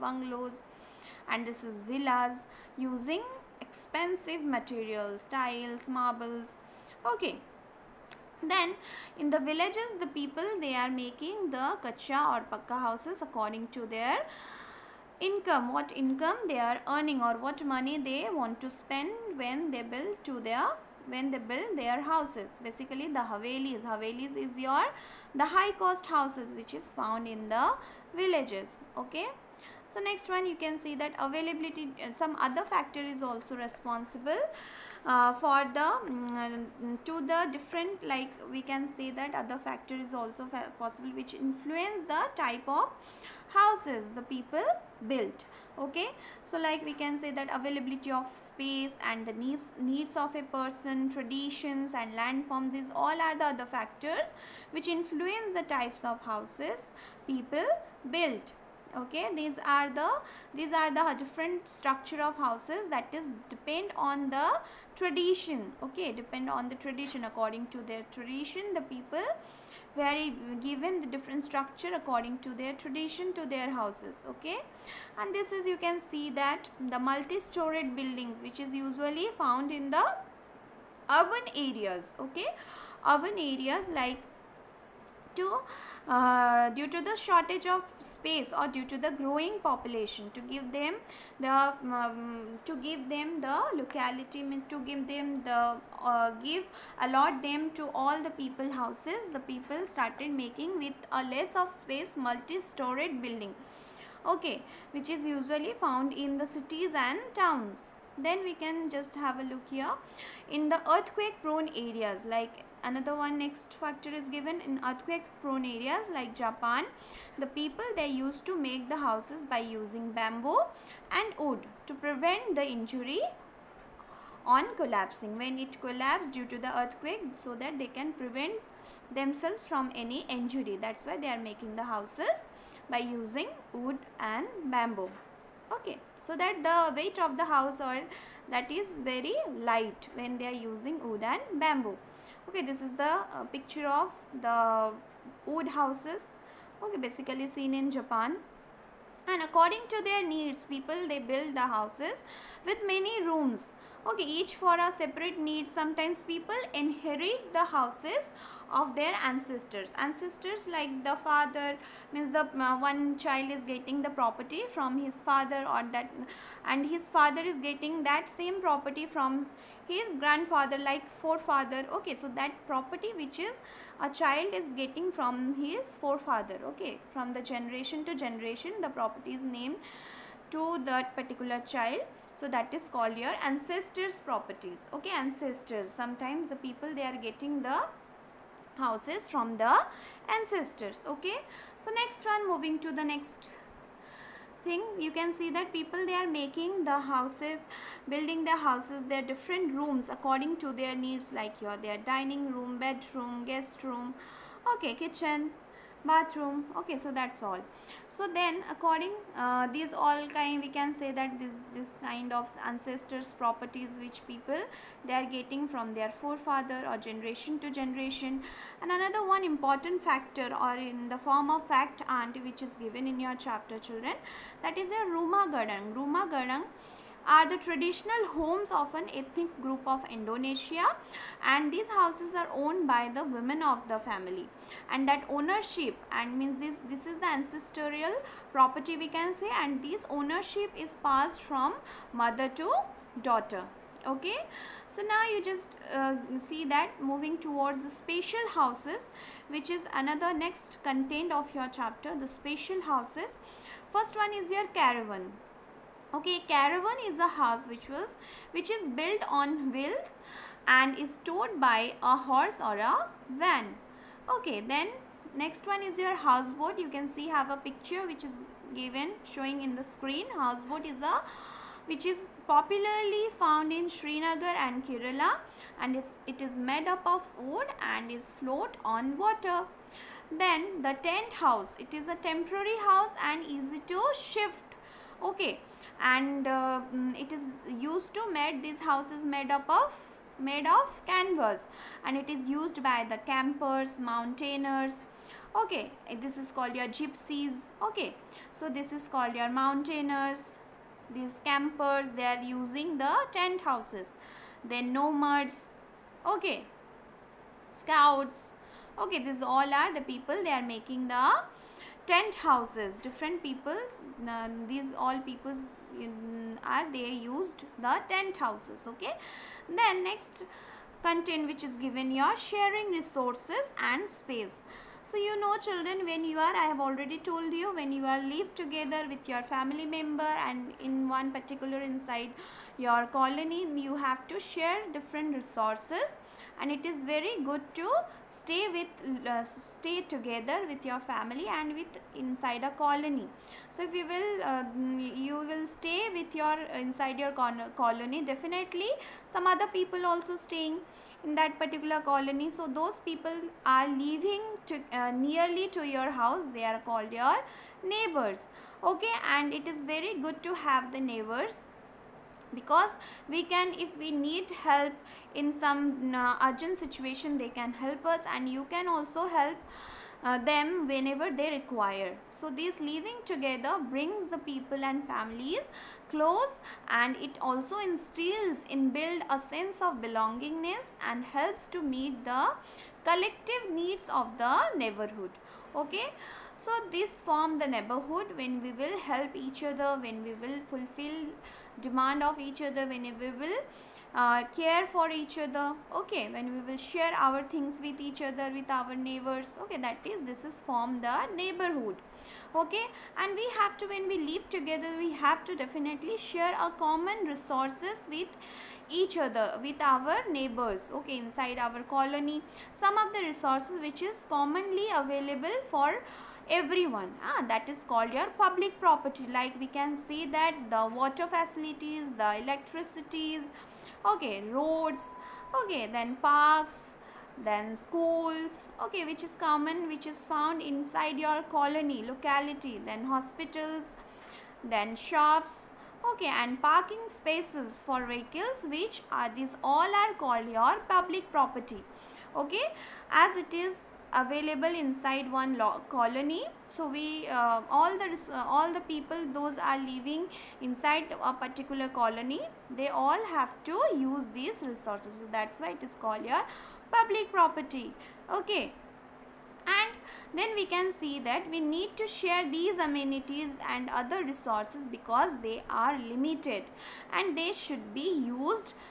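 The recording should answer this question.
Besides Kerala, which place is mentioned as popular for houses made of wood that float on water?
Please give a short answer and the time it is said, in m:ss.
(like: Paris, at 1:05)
Srinagar, at 4:33.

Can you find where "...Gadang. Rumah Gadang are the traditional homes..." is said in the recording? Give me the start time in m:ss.
3:45.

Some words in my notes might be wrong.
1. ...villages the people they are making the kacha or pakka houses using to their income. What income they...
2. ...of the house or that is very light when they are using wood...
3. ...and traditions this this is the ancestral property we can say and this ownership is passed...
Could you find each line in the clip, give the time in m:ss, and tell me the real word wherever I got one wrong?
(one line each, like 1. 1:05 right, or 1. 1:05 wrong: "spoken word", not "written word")
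1. 0:09 wrong: "according", not "using"
2. 2:17 right
3. 3:56 wrong: "means", not "traditions".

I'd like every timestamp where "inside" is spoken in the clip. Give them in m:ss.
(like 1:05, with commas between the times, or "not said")
5:31, 5:42, 5:46, 6:51, 7:10, 7:24, 7:30.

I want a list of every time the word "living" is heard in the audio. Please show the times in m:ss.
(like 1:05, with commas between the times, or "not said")
5:53, 6:12, 7:29.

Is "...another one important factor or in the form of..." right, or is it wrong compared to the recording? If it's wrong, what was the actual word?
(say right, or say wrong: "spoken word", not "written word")
right.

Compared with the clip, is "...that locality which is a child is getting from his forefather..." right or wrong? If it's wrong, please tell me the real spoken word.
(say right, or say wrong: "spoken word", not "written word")
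wrong: "property", not "locality".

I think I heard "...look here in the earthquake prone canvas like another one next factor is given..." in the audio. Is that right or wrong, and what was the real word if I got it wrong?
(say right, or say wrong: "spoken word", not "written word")
wrong: "areas", not "canvas".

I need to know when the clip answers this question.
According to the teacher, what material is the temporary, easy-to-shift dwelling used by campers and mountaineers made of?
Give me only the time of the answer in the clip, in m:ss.
4:51.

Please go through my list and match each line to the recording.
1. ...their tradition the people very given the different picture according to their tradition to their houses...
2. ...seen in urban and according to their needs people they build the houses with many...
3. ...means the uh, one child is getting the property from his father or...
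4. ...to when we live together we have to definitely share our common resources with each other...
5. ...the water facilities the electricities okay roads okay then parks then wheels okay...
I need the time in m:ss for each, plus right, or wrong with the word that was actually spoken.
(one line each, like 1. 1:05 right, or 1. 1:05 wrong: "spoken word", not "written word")
1. 1:07 wrong: "structure", not "picture"
2. 2:27 wrong: "japan", not "urban"
3. 2:42 right
4. 6:43 right
5. 7:00 wrong: "schools", not "wheels".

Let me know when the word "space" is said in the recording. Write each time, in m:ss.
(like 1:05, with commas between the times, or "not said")
0:48, 1:27, 1:41, 5:24, 7:17.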